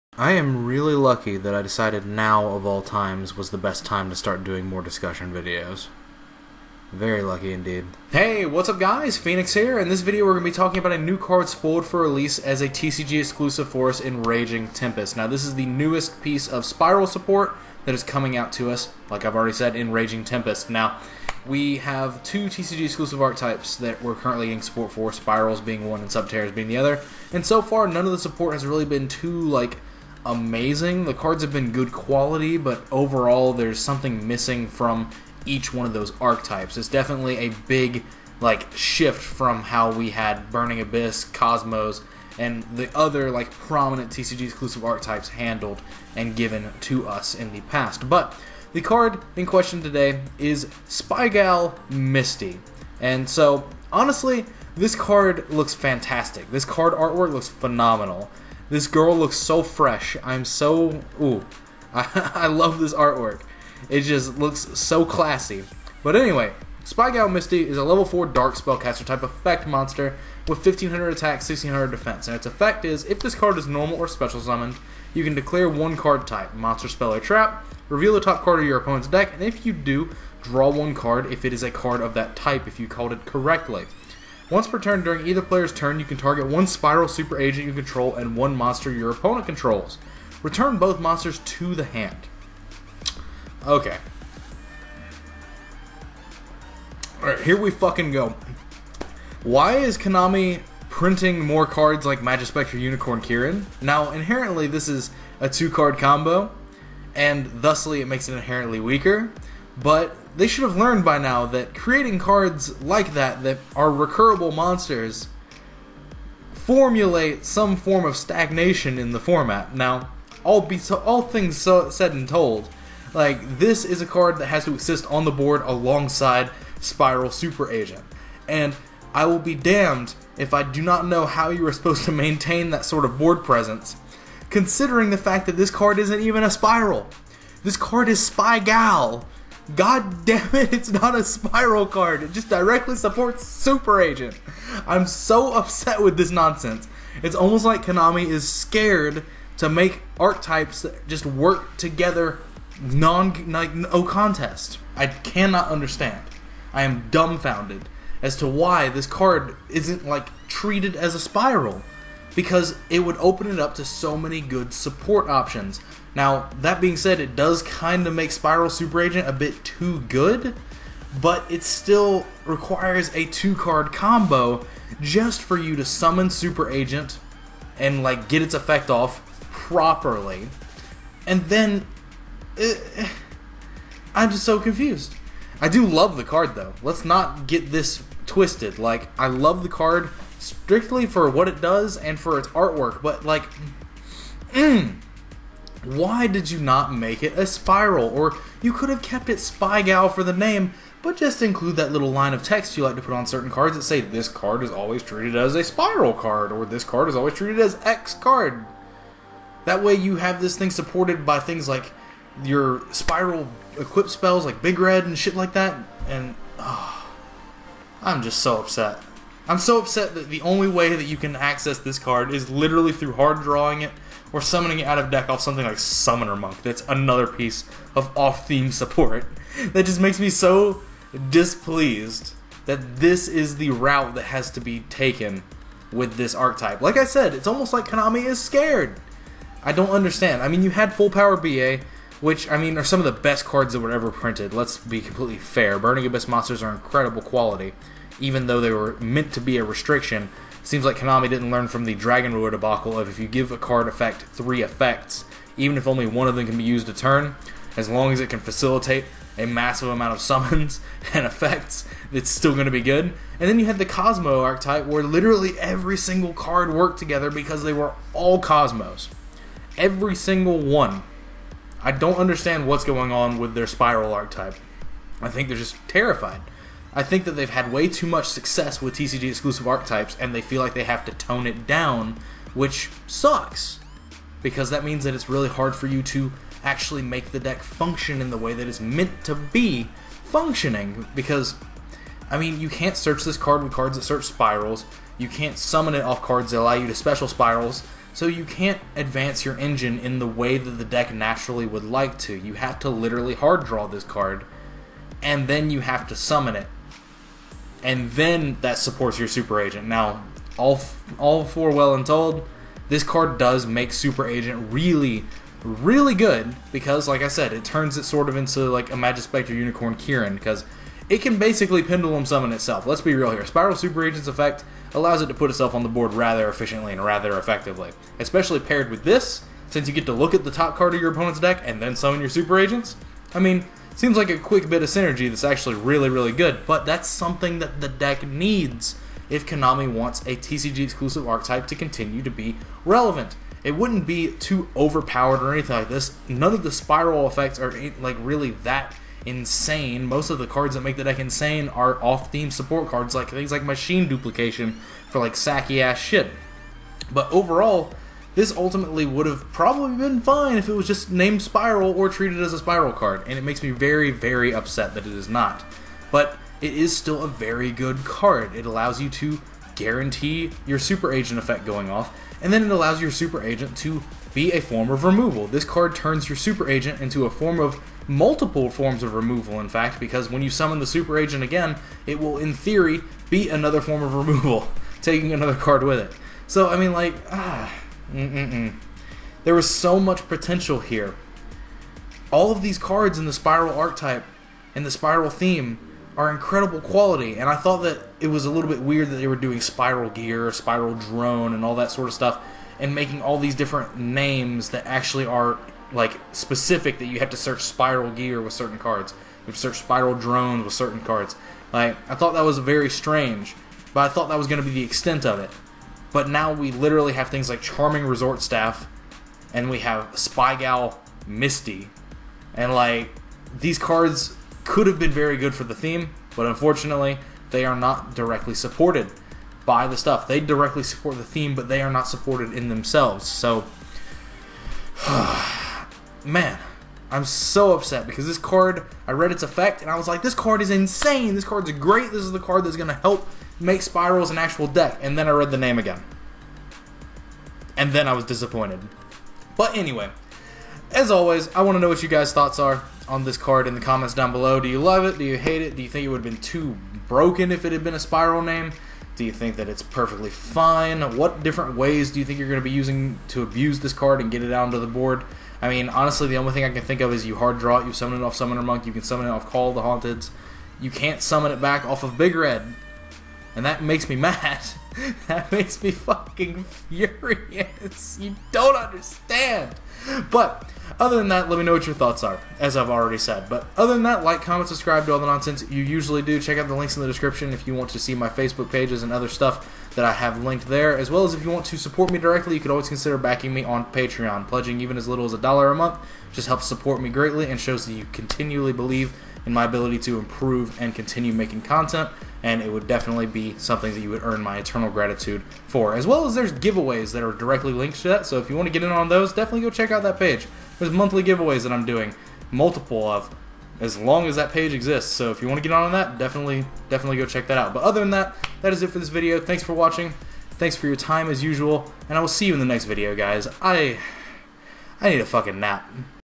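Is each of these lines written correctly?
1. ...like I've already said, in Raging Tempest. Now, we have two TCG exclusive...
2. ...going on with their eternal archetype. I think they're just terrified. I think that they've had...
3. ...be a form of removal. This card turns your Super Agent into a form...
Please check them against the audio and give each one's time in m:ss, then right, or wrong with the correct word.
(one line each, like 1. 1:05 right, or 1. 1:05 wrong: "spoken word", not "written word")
1. 0:19 right
2. 4:32 wrong: "spyral", not "eternal"
3. 6:14 right.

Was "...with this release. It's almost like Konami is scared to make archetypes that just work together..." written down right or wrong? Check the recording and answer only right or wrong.
wrong.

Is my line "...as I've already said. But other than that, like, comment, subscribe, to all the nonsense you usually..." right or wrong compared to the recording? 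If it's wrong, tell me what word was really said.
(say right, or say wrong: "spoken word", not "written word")
right.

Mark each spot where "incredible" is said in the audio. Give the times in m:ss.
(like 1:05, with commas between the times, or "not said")
4:06, 6:36.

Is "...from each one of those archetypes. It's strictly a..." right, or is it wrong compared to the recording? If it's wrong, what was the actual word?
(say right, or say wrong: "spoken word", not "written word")
wrong: "definitely", not "strictly".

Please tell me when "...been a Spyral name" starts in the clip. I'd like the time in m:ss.
7:37.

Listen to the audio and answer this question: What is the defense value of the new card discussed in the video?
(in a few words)
1600.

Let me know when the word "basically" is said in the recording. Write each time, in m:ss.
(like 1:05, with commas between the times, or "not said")
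5:21.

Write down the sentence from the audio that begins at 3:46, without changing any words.
That's another piece of off theme support.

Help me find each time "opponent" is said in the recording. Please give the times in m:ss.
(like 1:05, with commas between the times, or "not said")
1:18, 1:29, 5:31.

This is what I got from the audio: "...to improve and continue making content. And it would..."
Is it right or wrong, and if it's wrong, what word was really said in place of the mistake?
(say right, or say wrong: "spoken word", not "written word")
right.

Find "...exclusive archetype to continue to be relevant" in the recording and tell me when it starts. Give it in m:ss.
5:40.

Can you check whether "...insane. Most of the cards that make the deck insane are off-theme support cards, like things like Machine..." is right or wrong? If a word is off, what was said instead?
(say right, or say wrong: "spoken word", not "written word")
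right.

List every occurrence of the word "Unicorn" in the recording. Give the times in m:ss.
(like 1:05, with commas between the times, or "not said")
1:42, 5:19.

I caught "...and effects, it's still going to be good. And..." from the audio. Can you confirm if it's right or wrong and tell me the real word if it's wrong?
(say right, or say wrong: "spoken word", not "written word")
right.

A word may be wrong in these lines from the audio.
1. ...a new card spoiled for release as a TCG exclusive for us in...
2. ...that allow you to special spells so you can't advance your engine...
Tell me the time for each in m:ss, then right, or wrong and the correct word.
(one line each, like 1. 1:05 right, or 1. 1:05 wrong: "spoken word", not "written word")
1. 0:10 right
2. 4:56 wrong: "spyrals", not "spells".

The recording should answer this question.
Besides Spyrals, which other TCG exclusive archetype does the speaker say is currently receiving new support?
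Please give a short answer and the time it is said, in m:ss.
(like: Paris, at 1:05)
Subterrors, at 0:26.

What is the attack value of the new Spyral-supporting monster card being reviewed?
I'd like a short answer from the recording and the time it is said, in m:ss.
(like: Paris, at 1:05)
1500, at 1:10.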